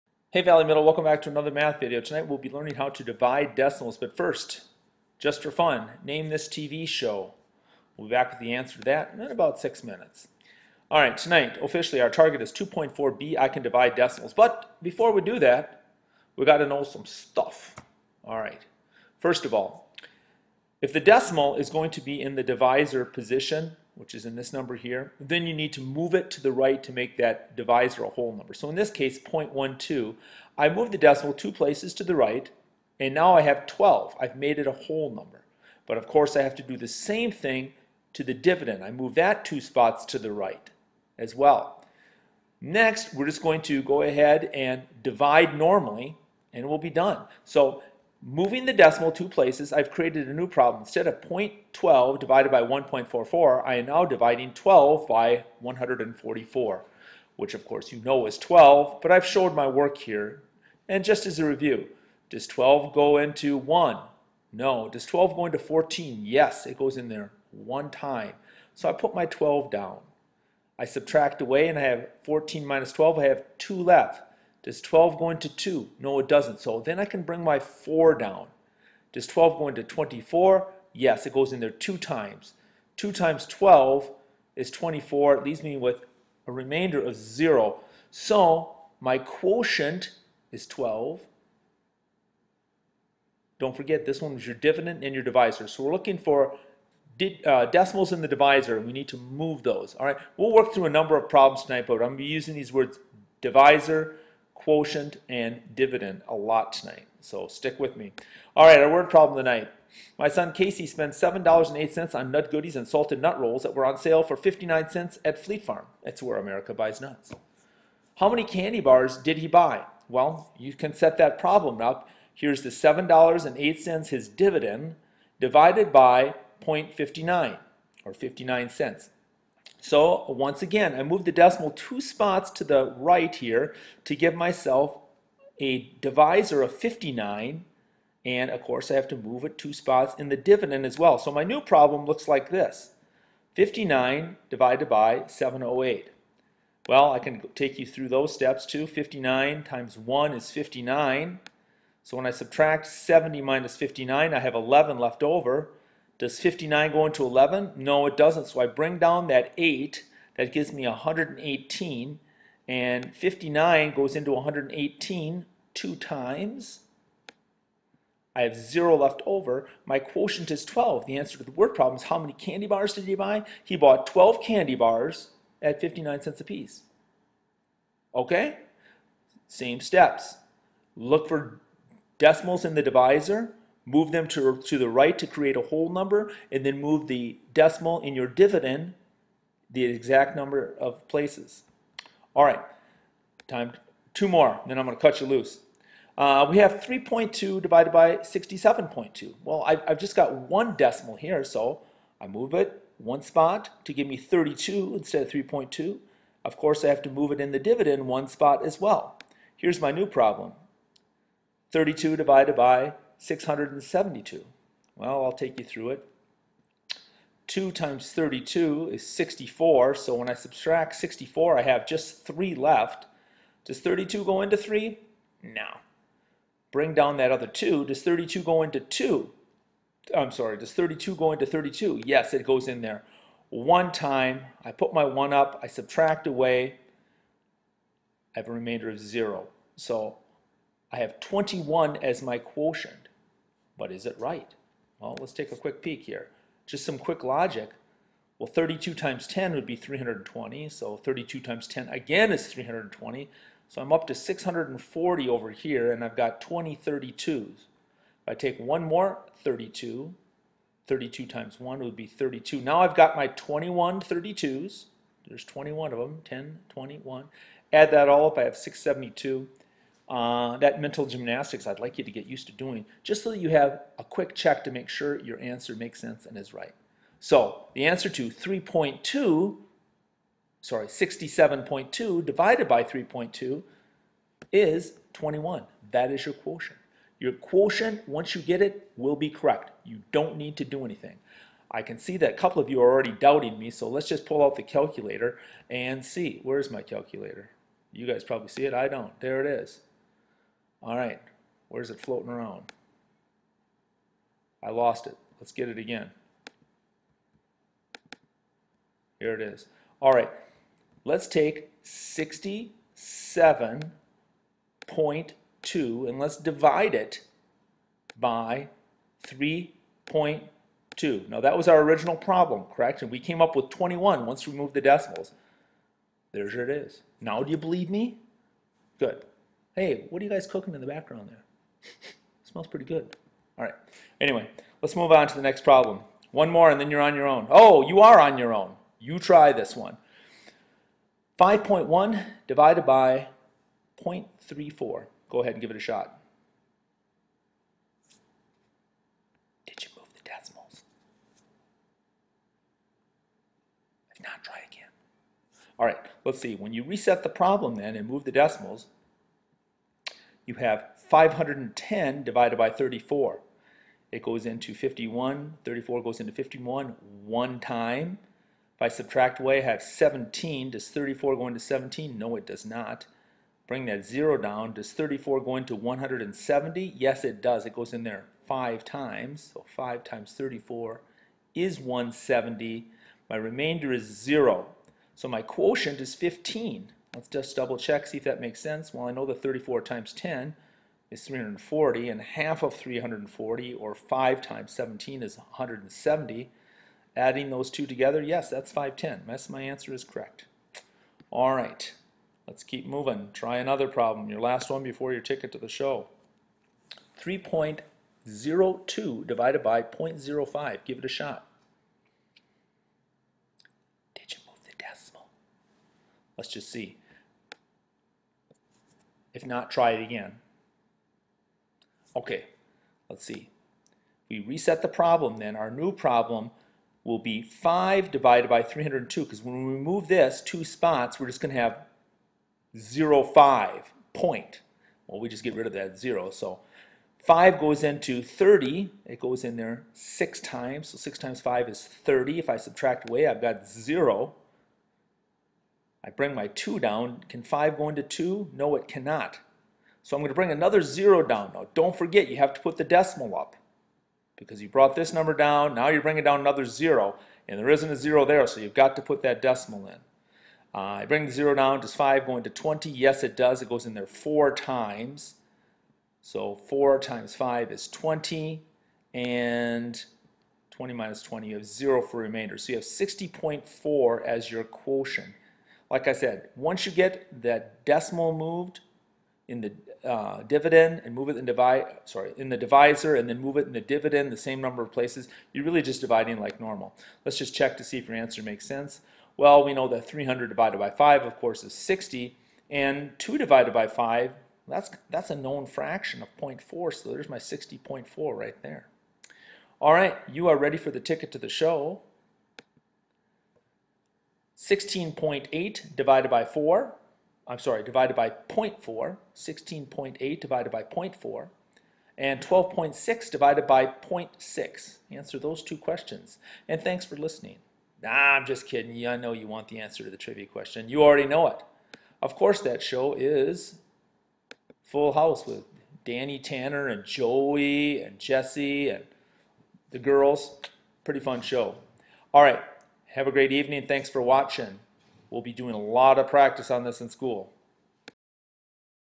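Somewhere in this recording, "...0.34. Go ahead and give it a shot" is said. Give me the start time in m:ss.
5:44.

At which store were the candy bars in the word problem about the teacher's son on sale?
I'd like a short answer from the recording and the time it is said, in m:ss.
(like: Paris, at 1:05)
Fleet Farm, at 1:55.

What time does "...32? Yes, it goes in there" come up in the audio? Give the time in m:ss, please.
3:51.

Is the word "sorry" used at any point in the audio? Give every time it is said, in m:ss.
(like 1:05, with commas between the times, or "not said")
3:50, 4:40, 8:02, 8:27.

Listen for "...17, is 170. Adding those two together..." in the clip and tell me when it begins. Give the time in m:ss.
6:34.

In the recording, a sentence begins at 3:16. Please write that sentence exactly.
Uh, we have 3.2 divided by 67.2.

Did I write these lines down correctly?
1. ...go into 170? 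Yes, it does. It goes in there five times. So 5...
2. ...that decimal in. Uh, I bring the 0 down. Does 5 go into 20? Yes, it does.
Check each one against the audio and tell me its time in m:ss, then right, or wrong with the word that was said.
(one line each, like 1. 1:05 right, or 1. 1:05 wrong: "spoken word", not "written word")
1. 6:15 right
2. 7:39 right.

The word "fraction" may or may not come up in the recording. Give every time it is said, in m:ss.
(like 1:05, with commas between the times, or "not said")
8:15.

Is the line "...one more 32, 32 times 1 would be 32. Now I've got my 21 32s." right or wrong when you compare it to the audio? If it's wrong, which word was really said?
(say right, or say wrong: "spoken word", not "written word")
right.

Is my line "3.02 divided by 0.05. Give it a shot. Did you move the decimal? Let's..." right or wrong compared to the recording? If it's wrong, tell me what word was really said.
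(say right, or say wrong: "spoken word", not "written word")
right.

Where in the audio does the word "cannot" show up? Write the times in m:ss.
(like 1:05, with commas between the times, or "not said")
7:28.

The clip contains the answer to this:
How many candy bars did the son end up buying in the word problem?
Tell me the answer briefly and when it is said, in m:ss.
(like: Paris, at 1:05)
12, at 2:53.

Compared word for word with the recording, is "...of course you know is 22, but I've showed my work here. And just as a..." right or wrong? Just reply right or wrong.
wrong.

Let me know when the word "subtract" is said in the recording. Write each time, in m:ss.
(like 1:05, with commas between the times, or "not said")
1:10, 2:32, 3:40, 3:55, 6:08, 7:22.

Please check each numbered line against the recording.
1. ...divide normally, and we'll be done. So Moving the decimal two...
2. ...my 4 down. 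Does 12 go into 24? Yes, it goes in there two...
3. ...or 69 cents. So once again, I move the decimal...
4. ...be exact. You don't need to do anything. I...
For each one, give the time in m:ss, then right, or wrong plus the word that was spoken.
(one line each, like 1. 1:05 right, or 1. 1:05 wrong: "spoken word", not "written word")
1. 0:45 right
2. 1:17 right
3. 2:08 wrong: "59", not "69"
4. 4:49 wrong: "correct", not "exact".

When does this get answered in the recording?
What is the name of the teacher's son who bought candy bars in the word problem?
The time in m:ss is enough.
1:50.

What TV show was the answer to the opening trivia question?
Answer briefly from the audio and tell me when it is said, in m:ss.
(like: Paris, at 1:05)
Full House, at 8:44.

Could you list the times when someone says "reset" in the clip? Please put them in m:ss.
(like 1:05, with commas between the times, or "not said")
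5:56, 7:04.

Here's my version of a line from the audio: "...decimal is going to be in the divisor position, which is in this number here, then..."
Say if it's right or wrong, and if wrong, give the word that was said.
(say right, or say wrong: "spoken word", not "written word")
right.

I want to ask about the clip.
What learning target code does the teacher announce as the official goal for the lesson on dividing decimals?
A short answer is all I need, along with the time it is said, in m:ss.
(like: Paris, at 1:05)
2.4b, at 0:12.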